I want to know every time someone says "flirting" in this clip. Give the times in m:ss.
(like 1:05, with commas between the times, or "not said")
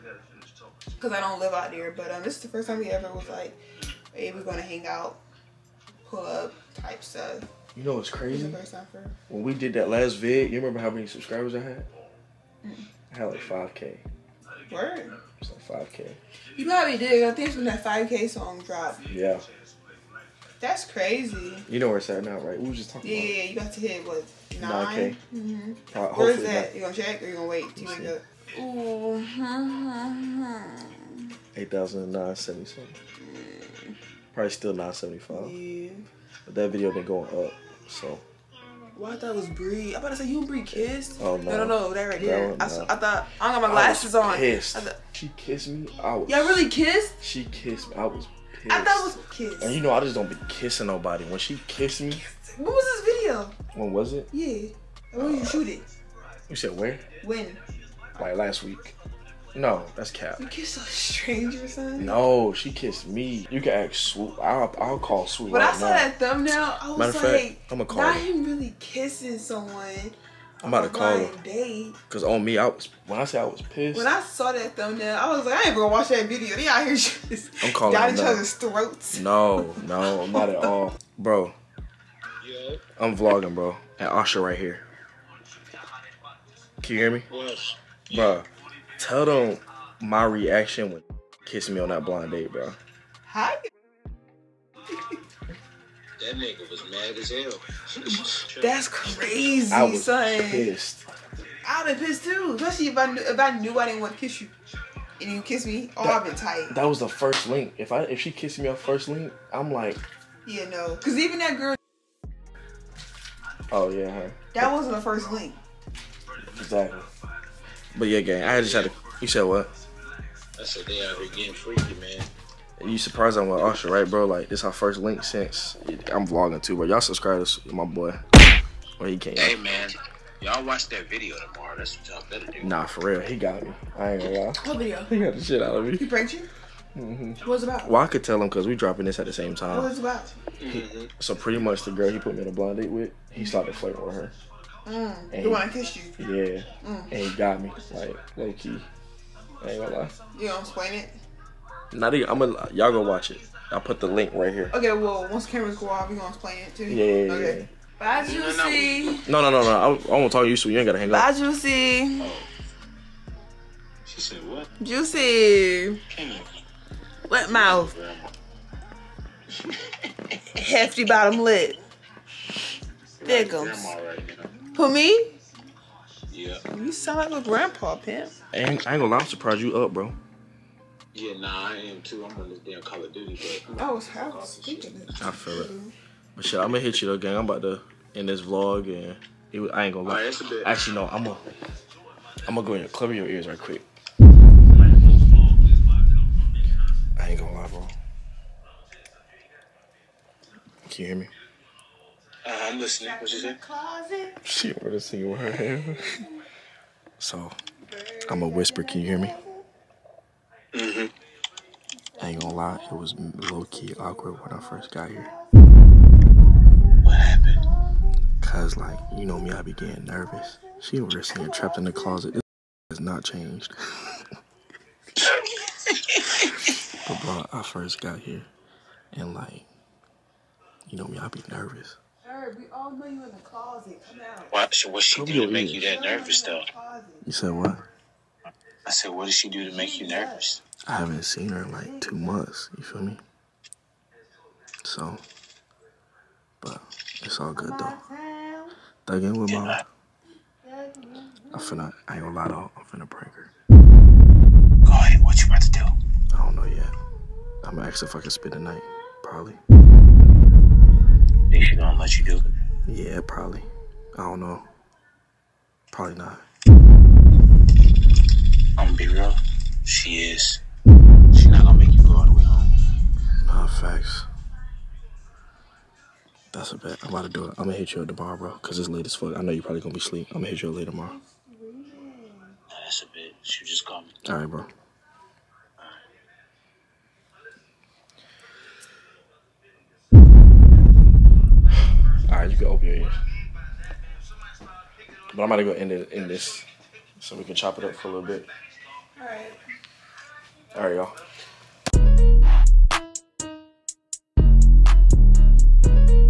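2:23.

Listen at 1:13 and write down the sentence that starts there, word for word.
When I saw that thumbnail, I was like, I ain't gonna watch that video.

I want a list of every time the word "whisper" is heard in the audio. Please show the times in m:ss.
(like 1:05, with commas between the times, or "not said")
3:28.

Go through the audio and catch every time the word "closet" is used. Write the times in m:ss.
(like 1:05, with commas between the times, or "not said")
3:23, 3:41, 3:53.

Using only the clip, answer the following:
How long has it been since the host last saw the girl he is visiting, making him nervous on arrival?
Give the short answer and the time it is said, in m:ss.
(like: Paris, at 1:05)
2 months, at 4:02.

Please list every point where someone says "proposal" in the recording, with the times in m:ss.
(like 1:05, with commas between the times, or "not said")
not said.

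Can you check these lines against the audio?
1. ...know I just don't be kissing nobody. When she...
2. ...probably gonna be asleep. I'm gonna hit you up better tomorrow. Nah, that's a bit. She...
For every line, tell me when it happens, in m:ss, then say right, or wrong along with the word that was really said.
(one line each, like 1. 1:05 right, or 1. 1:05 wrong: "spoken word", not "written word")
1. 0:49 right
2. 4:39 wrong: "later", not "better".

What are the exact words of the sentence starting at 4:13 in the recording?
Go ahead, what you about to do?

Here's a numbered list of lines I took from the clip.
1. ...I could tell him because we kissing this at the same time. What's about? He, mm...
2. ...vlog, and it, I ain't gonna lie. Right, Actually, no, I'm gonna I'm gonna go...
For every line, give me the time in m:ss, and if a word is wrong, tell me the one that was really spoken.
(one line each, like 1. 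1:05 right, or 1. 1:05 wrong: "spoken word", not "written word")
1. 2:18 wrong: "dropping", not "kissing"
2. 3:08 right.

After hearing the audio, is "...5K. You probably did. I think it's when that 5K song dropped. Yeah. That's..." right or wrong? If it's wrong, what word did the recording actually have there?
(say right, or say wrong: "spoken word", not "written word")
right.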